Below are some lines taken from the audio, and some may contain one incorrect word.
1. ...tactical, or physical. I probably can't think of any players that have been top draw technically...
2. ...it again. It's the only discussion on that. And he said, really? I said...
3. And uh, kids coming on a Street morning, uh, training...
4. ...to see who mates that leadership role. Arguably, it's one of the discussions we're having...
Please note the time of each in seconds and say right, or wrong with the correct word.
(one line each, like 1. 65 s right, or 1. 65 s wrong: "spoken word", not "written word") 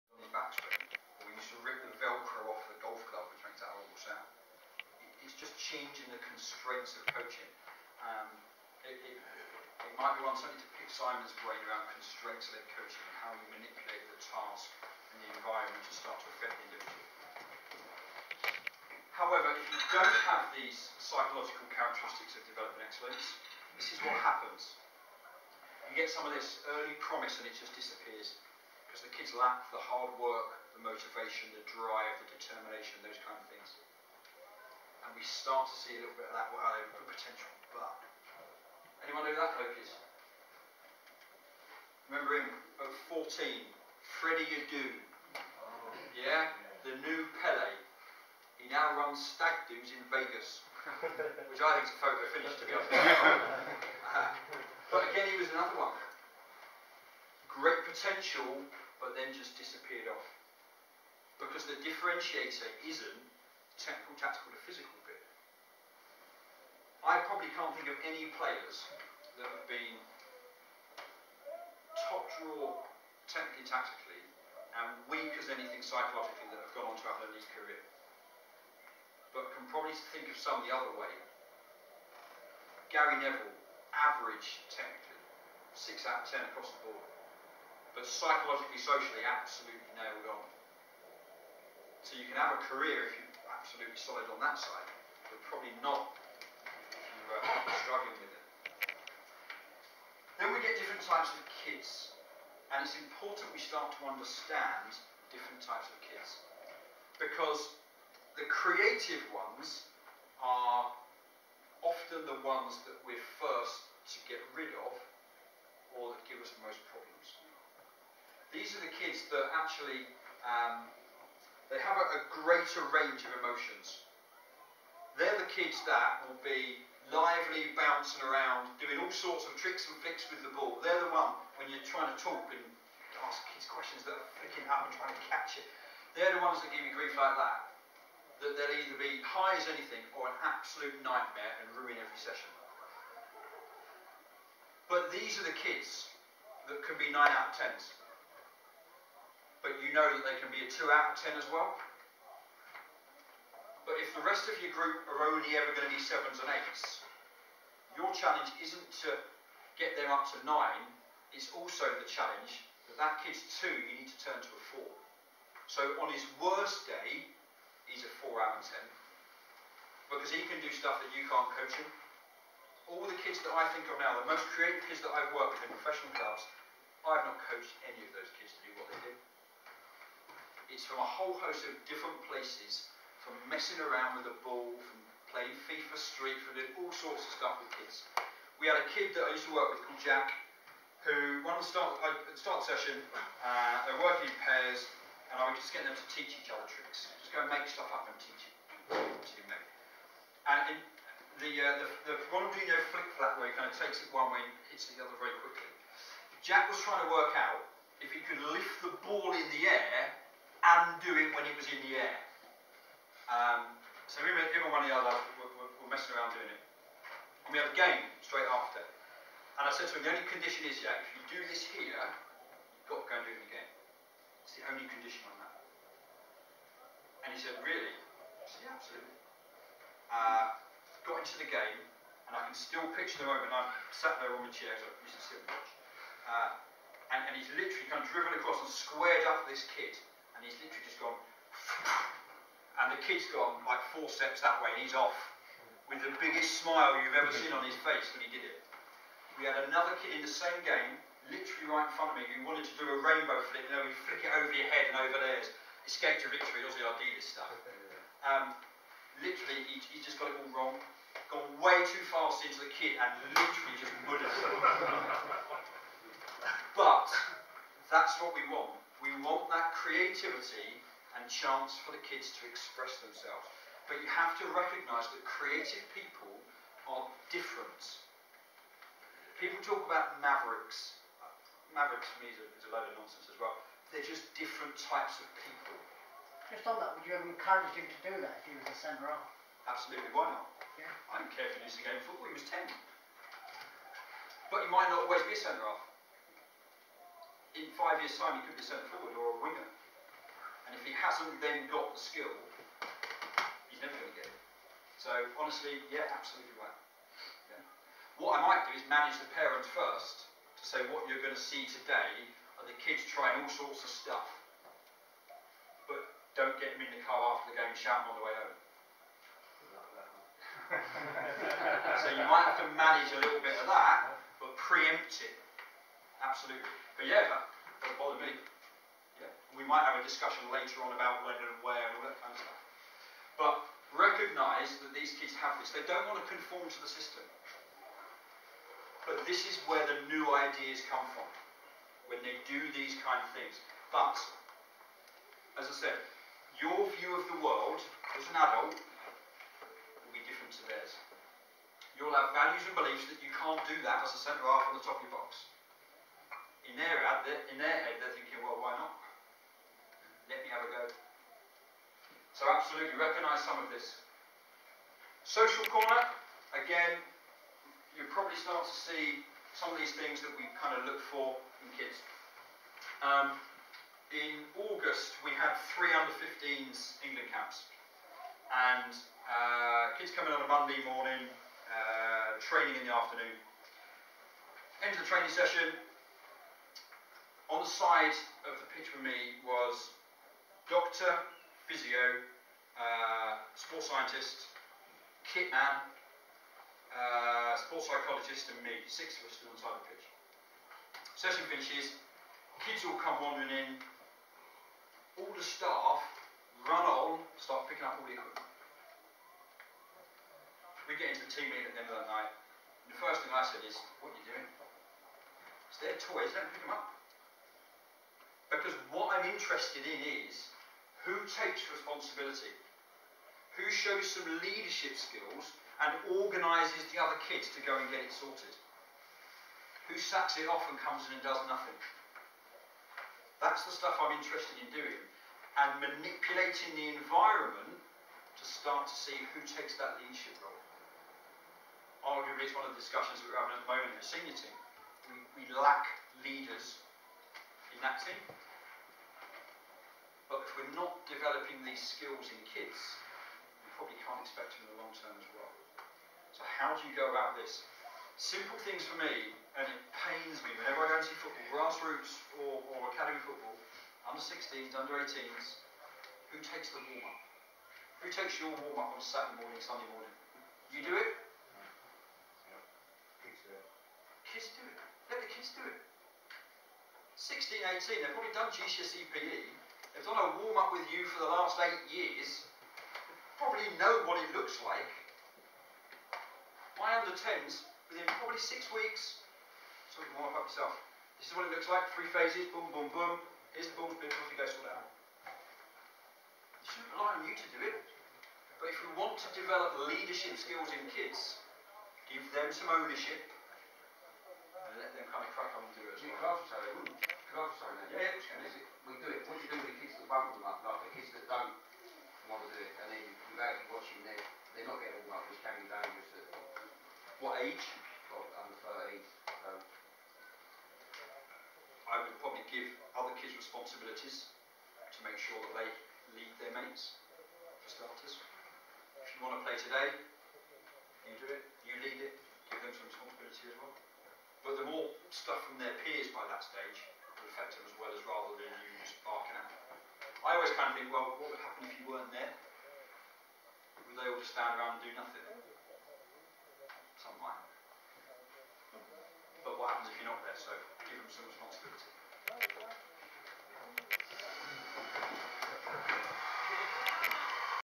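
1. 64 s right
2. 223 s wrong: "condition", not "discussion"
3. 378 s wrong: "Monday", not "Street"
4. 438 s wrong: "takes", not "mates".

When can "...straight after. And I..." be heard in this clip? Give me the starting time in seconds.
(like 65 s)
218 s.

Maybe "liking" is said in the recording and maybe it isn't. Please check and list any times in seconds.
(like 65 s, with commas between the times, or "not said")
not said.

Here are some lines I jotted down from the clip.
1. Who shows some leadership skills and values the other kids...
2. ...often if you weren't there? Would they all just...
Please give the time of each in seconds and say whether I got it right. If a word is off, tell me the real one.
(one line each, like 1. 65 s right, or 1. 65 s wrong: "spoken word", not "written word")
1. 423 s wrong: "organises", not "values"
2. 541 s wrong: "happen", not "often".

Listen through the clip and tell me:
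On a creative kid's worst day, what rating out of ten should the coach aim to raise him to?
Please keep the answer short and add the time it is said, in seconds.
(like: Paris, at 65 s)
4, at 168 s.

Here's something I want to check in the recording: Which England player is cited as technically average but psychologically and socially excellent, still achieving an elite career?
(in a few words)
Gary Neville.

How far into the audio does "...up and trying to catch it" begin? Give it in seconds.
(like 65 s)
134 s.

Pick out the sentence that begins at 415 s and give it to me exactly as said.
It's their toys, don't pick them up.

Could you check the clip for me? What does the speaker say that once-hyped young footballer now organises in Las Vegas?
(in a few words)
Stag doos.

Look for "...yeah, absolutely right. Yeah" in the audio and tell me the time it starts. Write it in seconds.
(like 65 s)
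305 s.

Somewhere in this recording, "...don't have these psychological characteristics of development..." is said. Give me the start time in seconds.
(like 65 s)
19 s.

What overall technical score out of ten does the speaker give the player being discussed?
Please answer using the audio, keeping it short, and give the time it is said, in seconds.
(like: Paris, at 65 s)
6, at 85 s.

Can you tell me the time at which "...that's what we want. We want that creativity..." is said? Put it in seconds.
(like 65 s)
267 s.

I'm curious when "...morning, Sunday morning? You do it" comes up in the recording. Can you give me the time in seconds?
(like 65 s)
469 s.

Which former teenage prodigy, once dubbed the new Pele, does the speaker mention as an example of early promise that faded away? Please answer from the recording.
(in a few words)
Freddie Adu.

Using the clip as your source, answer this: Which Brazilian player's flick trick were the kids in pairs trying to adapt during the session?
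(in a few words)
Ronaldinho.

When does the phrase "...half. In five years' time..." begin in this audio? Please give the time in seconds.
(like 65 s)
295 s.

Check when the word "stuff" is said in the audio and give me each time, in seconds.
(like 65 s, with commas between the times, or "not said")
170 s, 187 s, 197 s, 257 s, 313 s, 332 s, 433 s, 535 s.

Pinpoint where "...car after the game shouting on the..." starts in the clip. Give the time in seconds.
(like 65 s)
317 s.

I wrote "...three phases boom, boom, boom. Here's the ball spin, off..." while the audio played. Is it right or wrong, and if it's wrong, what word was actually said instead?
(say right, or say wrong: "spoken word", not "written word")
right.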